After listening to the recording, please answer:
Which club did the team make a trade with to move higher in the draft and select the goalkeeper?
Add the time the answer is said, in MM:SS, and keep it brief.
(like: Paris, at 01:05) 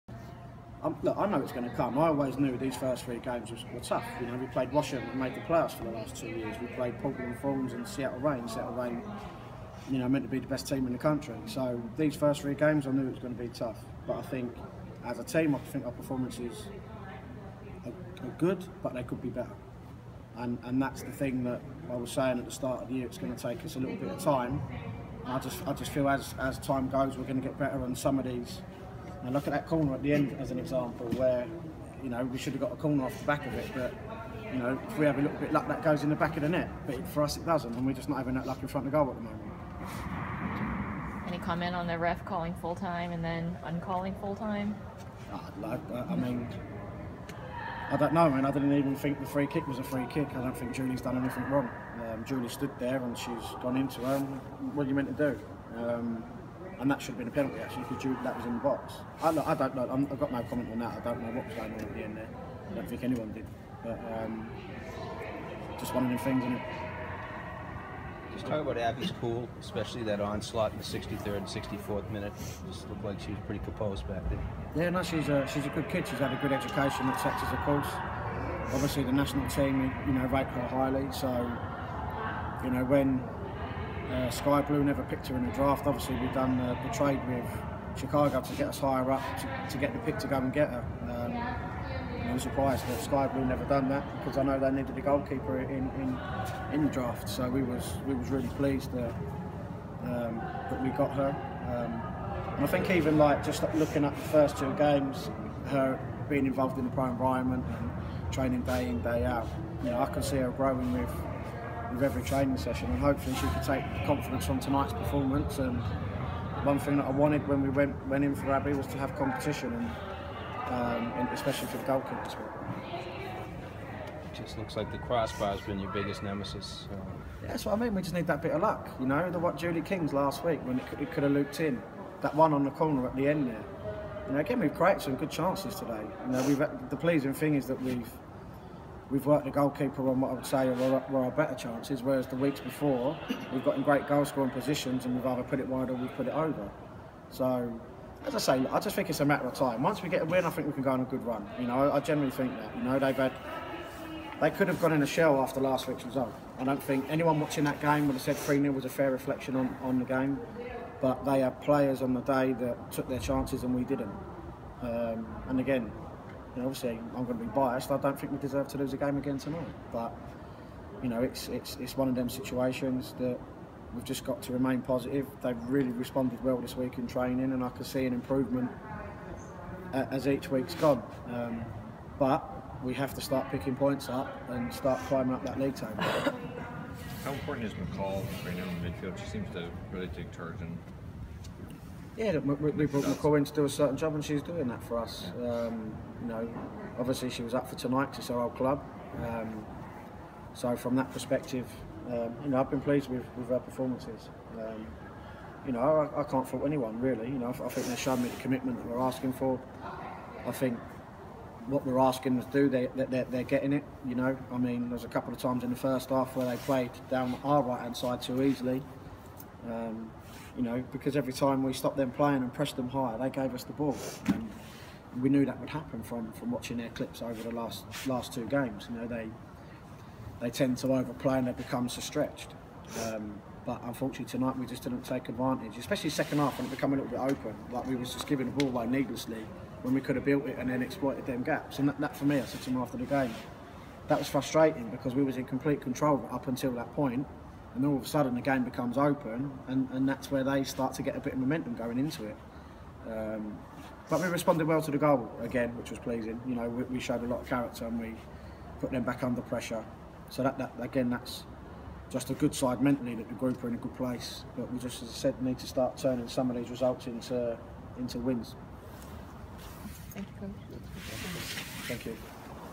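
Chicago, at 01:27.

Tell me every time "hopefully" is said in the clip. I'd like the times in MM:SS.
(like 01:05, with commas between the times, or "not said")
01:52.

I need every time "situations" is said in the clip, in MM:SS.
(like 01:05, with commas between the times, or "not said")
02:52.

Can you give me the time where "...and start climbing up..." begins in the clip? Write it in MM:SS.
03:04.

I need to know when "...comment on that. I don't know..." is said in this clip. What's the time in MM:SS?
01:00.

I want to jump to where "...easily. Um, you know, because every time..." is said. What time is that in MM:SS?
03:38.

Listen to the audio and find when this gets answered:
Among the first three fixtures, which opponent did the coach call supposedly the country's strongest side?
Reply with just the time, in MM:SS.
00:08.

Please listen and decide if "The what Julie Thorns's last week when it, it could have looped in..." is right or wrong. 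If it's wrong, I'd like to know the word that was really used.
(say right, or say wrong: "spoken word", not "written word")
wrong: "King", not "Thorns".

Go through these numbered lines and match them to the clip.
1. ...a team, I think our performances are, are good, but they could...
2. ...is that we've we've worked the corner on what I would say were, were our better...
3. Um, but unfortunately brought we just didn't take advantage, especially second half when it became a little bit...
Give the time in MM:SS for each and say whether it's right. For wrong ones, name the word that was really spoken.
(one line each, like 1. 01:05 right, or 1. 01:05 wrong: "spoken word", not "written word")
1. 00:15 right
2. 02:17 wrong: "goalkeeper", not "corner"
3. 03:53 wrong: "tonight", not "brought".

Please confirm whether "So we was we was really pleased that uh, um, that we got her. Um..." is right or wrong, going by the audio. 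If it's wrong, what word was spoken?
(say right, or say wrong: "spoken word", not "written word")
right.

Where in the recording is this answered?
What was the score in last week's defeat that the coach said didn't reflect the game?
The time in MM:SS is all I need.
02:38.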